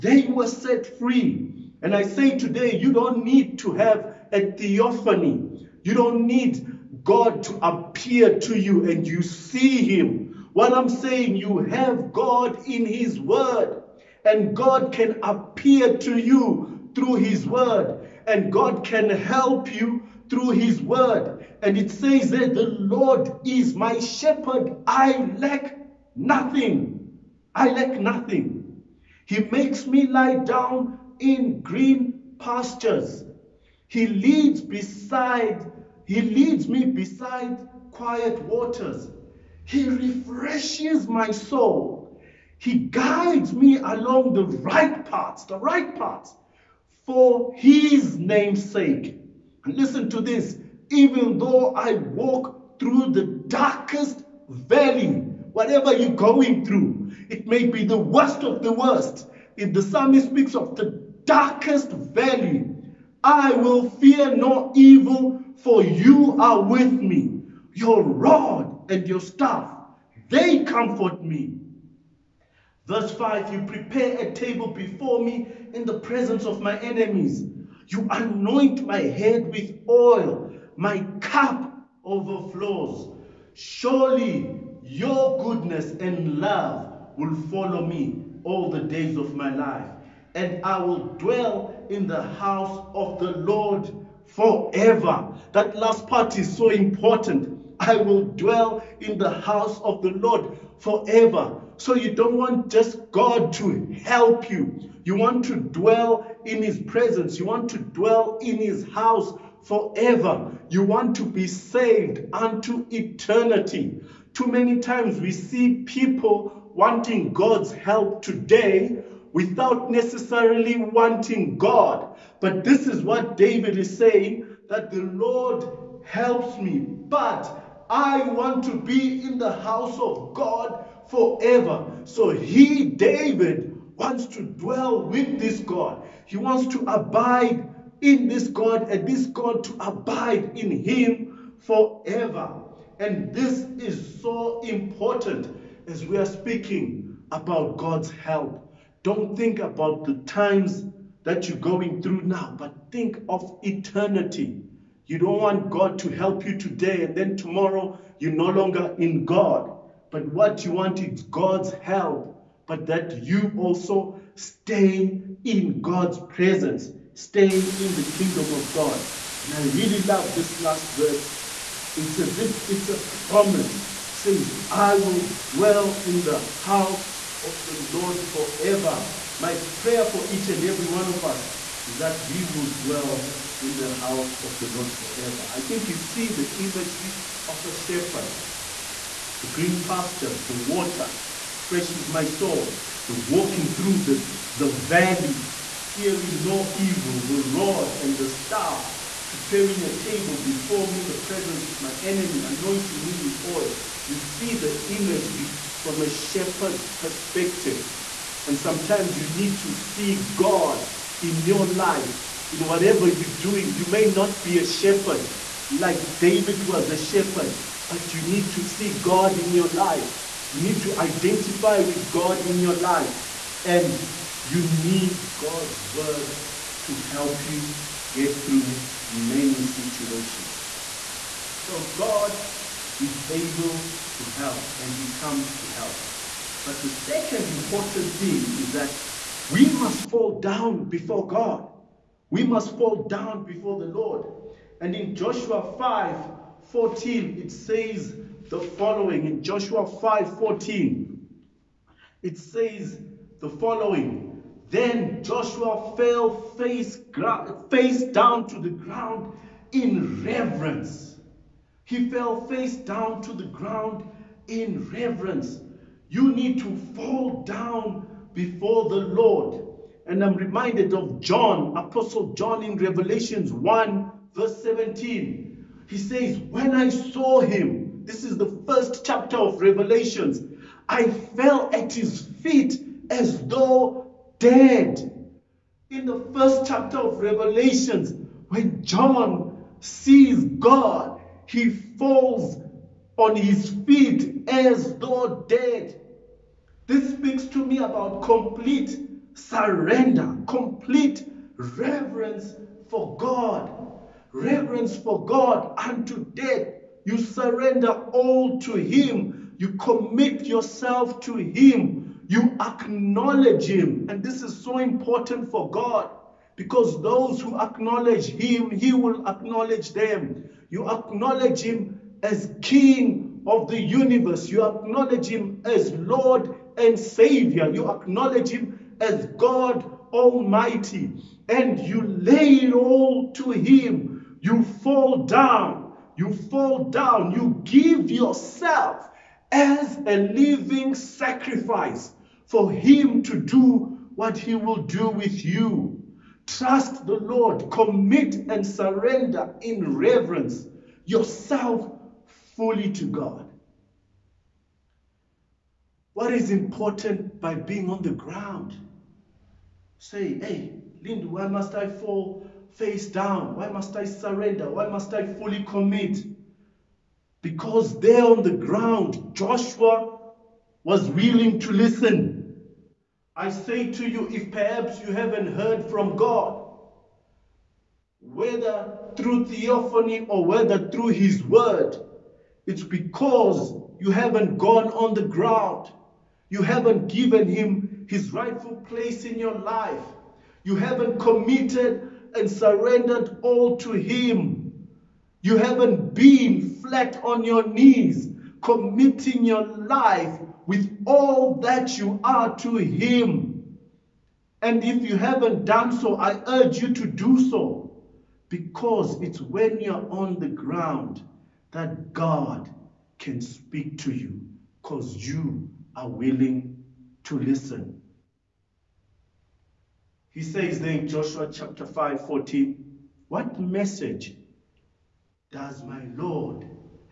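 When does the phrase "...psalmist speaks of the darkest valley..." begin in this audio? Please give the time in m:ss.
0:59.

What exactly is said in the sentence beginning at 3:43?
And you need God's word to help you get through many situations.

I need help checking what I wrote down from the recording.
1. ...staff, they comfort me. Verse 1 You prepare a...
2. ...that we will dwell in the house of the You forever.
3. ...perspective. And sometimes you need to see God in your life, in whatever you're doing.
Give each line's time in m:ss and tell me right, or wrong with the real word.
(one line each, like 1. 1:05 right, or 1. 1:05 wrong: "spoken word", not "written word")
1. 1:09 wrong: "5", not "1"
2. 3:01 wrong: "Lord", not "You"
3. 3:26 right.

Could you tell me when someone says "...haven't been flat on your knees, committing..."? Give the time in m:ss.
6:35.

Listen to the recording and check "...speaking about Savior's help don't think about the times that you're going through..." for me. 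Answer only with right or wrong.
wrong.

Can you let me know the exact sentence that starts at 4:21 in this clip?
He fell face down to the ground in reverence.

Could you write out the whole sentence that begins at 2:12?
So he, David, wants to dwell with this God.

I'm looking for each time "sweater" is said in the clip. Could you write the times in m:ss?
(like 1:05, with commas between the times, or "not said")
not said.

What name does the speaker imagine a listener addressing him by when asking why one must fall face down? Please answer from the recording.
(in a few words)
Lindu.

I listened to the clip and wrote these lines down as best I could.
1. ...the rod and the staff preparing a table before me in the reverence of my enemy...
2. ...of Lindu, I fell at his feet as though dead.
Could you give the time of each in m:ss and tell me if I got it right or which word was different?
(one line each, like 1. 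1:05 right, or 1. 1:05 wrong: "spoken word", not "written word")
1. 3:17 wrong: "presence", not "reverence"
2. 4:39 wrong: "Revelations", not "Lindu".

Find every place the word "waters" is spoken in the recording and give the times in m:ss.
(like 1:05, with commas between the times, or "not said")
0:38, 3:10.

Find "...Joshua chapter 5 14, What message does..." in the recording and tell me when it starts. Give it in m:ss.
7:01.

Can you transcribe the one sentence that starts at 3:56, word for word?
But the second important thing is that we must fall down before God.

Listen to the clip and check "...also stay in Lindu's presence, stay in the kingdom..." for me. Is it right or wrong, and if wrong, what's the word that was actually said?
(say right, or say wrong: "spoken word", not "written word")
wrong: "God", not "Lindu".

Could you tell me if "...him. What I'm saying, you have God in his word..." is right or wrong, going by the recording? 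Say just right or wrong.
right.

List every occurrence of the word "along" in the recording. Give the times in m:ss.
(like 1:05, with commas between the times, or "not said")
0:43.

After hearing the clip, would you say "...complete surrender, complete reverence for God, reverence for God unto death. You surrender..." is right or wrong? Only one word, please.
right.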